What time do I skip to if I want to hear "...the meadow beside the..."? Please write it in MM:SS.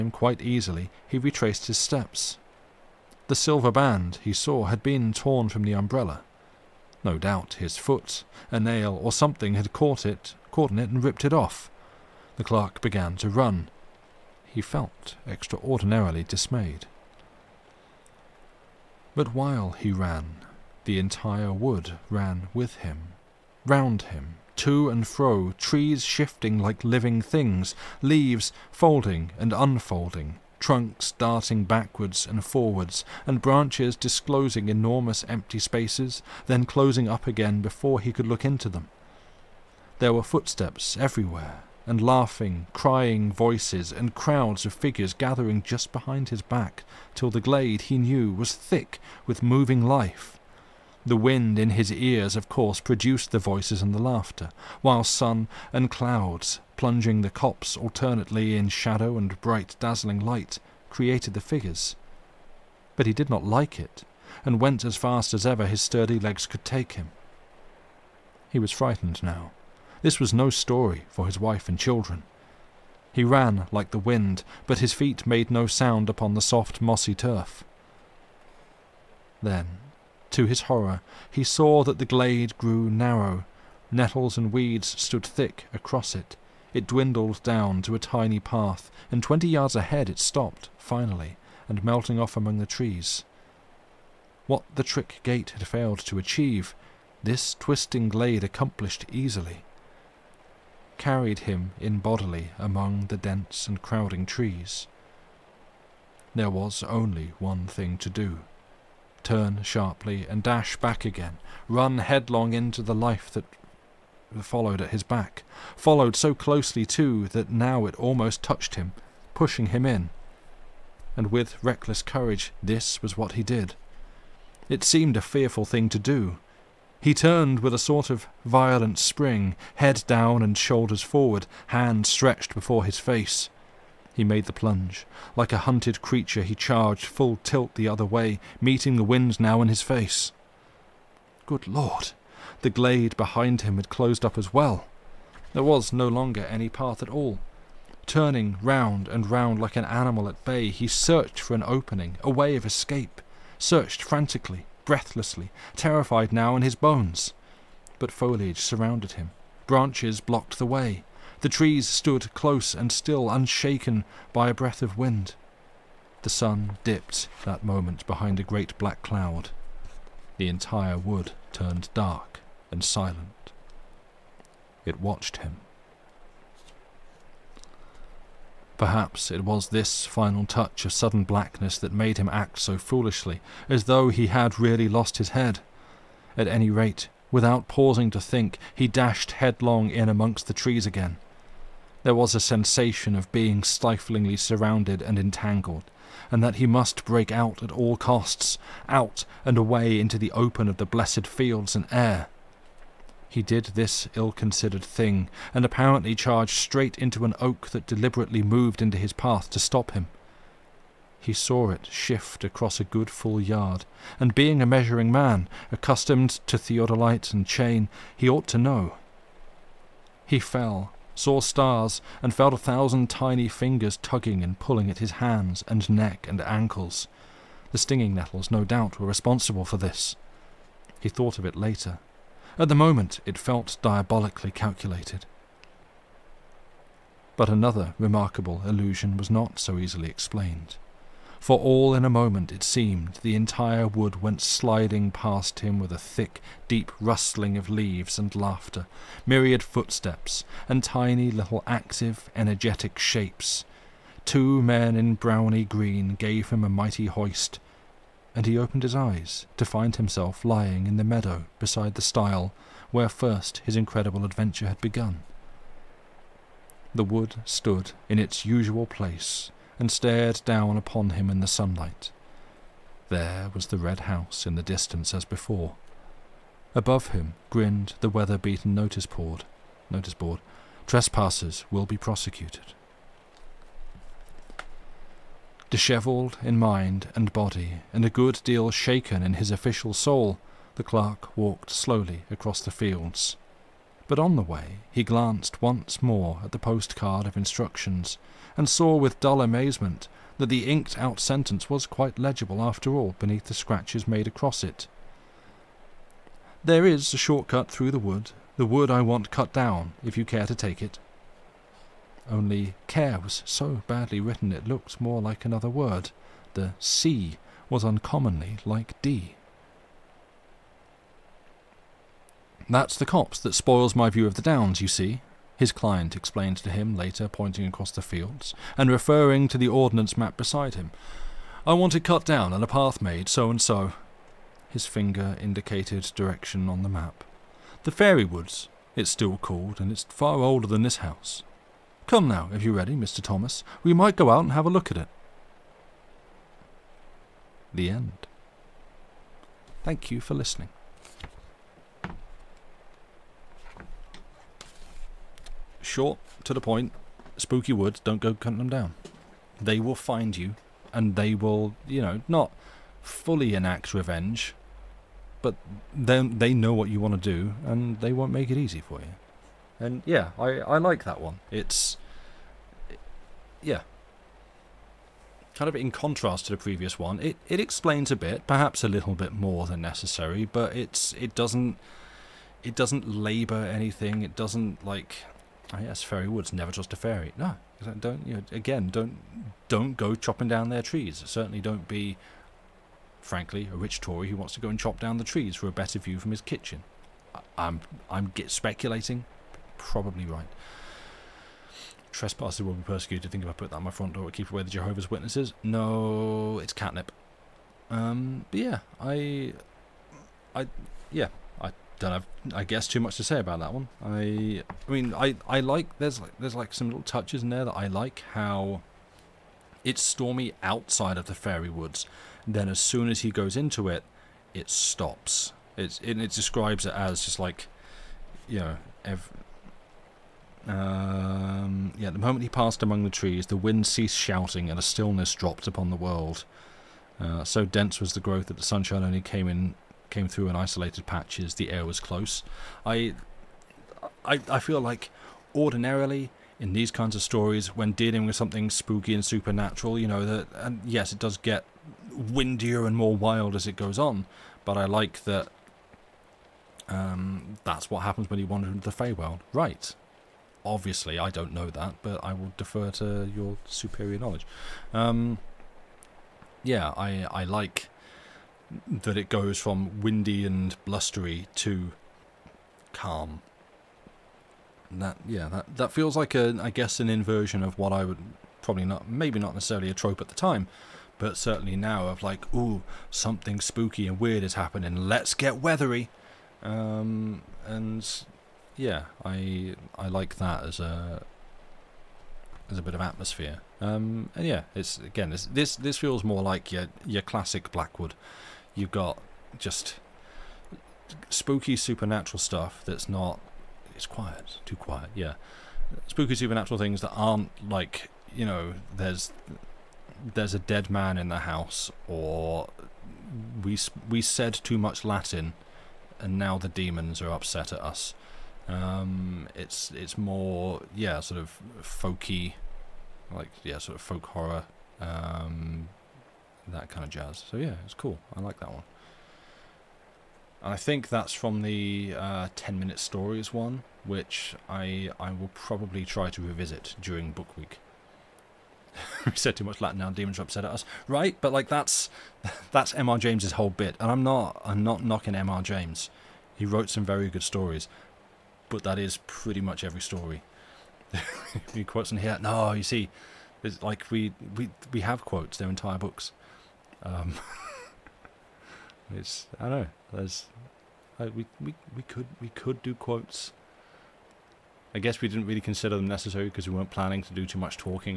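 04:20.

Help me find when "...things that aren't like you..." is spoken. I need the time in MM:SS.
08:26.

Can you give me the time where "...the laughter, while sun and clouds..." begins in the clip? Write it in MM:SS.
00:53.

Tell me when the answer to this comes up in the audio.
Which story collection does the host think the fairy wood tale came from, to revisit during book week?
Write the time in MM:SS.
08:52.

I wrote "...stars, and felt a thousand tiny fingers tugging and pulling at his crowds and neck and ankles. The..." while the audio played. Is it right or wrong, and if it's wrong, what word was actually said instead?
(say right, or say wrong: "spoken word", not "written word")
wrong: "hands", not "crowds".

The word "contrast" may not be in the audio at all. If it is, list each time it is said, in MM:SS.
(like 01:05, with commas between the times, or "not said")
06:15.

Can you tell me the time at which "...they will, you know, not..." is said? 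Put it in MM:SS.
06:01.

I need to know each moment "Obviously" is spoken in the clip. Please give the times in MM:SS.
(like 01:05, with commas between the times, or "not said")
07:40.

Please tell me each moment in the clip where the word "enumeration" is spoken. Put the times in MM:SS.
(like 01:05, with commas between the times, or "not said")
not said.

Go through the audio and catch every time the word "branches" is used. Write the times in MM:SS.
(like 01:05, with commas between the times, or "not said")
00:33, 02:39.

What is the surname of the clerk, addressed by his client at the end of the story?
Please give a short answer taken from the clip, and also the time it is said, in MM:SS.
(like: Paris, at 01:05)
Thomas, at 05:42.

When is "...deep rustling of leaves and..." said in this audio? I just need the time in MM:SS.
04:06.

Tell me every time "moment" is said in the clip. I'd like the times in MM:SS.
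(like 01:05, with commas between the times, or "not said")
02:47, 03:52, 04:02, 07:12.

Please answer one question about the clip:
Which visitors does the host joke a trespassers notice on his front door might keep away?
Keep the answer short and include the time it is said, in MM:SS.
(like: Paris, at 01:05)
Jehovah's Witnesses, at 06:44.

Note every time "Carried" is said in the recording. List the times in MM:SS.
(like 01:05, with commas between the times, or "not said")
01:40.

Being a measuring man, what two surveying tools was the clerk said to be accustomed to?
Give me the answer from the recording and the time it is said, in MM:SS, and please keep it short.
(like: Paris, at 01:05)
Theodolite and chain, at 03:36.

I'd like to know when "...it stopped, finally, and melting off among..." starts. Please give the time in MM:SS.
01:30.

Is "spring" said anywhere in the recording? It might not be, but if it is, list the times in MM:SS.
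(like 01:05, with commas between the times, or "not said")
02:08.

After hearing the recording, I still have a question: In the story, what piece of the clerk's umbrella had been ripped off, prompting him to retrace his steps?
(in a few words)
The silver band.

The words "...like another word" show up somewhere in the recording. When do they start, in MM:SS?
05:15.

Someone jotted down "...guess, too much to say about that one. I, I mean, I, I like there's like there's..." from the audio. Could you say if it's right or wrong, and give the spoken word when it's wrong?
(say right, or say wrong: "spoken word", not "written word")
right.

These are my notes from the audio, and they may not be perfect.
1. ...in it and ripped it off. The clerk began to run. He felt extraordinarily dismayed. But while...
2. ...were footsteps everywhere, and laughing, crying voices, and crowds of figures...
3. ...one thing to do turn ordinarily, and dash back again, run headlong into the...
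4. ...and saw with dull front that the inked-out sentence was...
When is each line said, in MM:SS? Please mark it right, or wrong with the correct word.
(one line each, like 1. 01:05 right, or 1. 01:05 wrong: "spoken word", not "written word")
1. 00:10 right
2. 00:40 right
3. 01:47 wrong: "sharply", not "ordinarily"
4. 04:58 wrong: "amazement", not "front".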